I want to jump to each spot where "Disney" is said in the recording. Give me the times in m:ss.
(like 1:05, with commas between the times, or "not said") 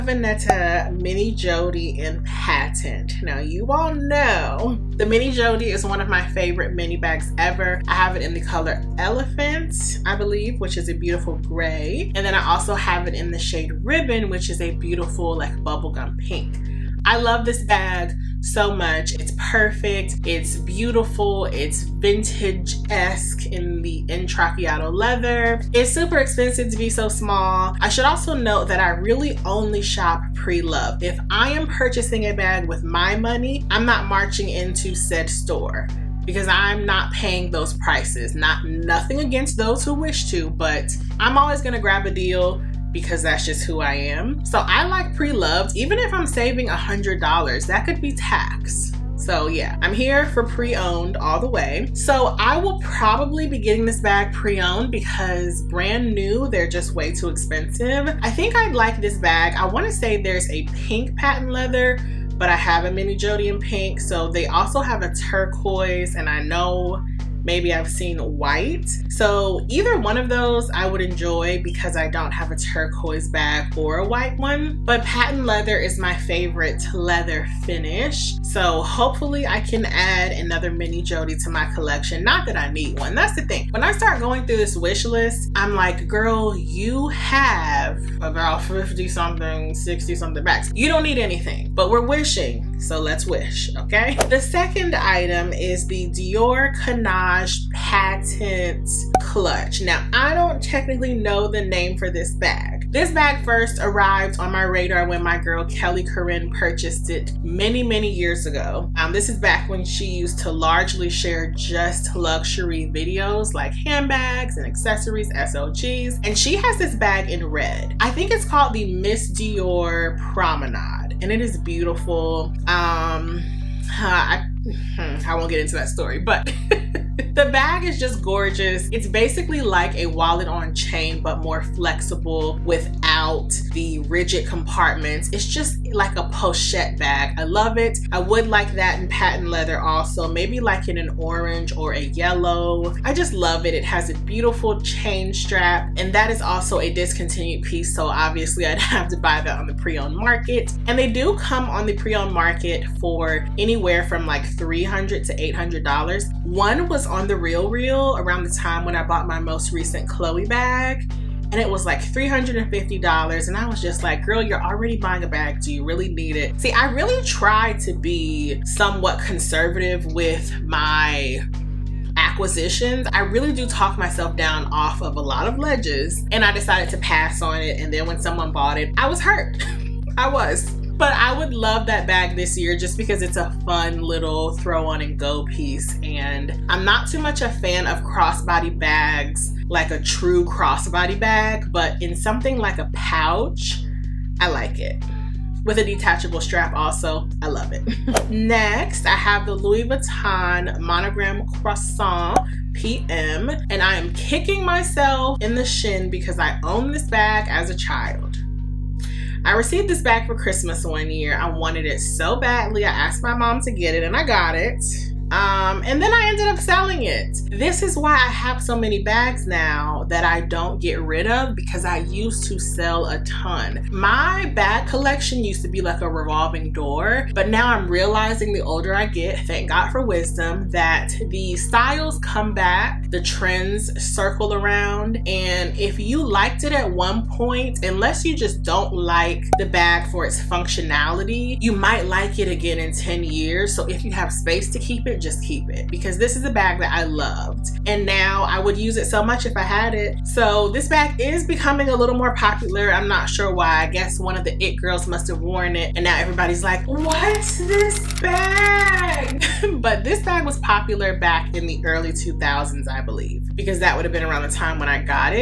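not said.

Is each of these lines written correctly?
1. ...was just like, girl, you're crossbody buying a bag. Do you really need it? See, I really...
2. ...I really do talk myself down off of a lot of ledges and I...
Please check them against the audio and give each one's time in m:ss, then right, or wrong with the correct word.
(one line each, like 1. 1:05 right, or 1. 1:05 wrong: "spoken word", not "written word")
1. 2:43 wrong: "already", not "crossbody"
2. 2:53 right.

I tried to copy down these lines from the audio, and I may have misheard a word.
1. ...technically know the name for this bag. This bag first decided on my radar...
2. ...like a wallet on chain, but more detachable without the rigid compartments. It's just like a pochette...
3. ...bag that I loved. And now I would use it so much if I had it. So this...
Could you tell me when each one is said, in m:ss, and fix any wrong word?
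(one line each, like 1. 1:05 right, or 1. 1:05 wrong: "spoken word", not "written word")
1. 1:40 wrong: "arrived", not "decided"
2. 2:09 wrong: "flexible", not "detachable"
3. 4:06 right.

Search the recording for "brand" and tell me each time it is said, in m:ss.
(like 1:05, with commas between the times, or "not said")
0:55.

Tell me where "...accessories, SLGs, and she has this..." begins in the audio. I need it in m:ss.
1:54.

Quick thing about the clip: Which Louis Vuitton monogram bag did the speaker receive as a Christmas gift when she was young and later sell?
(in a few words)
Croissant PM.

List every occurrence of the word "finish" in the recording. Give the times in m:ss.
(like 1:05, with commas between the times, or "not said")
1:17.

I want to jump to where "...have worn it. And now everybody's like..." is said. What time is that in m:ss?
4:15.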